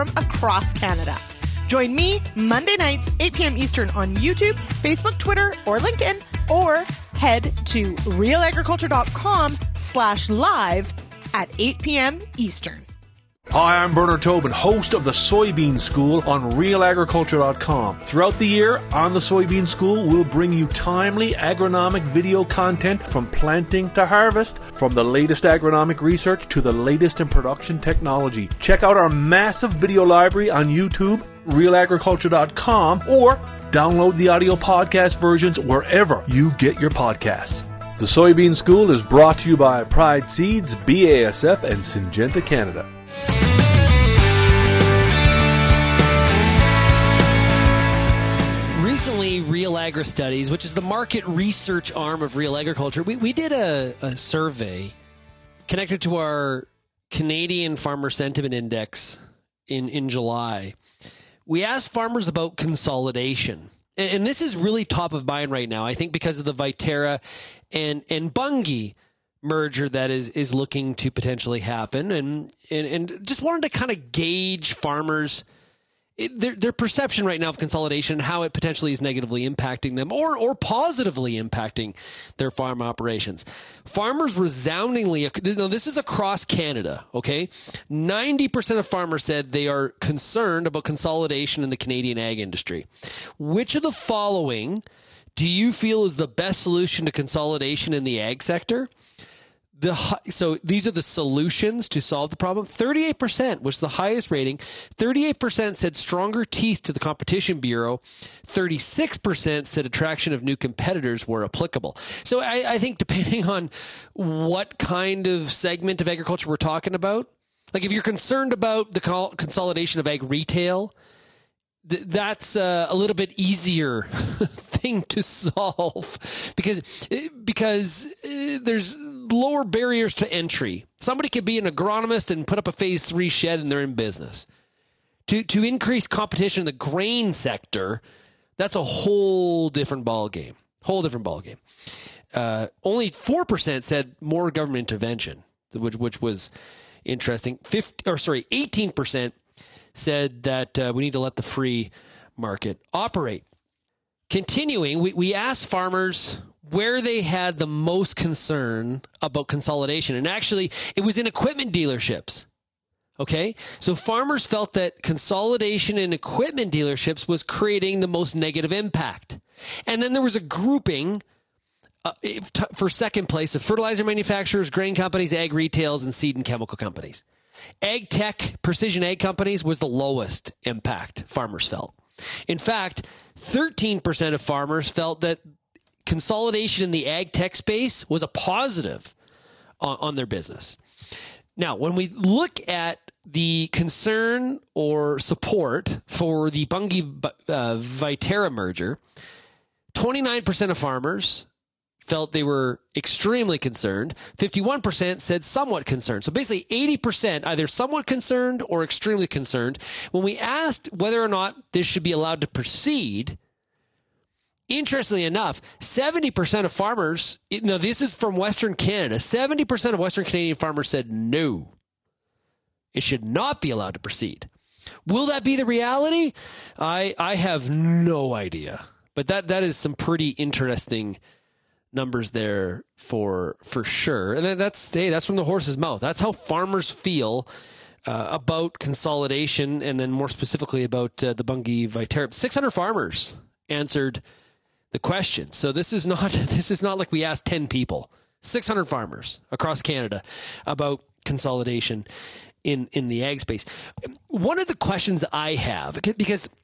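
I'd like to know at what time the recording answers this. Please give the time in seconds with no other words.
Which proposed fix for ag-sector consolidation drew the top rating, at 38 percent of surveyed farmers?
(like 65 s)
105 s.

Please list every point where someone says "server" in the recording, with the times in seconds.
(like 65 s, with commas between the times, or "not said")
not said.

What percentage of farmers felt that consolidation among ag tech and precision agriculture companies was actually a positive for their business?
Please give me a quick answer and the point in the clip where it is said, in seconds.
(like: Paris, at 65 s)
13%, at 183 s.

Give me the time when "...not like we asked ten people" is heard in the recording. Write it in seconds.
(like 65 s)
246 s.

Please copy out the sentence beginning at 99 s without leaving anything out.
The, so these are the solutions to solve the problem.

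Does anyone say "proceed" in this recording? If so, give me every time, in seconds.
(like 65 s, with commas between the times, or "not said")
212 s, 223 s.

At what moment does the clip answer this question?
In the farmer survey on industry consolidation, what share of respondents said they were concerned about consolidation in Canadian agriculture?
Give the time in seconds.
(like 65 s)
87 s.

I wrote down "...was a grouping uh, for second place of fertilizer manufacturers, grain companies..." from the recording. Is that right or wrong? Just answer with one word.
right.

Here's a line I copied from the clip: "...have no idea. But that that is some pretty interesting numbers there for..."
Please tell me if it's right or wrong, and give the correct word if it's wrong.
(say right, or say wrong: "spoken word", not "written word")
right.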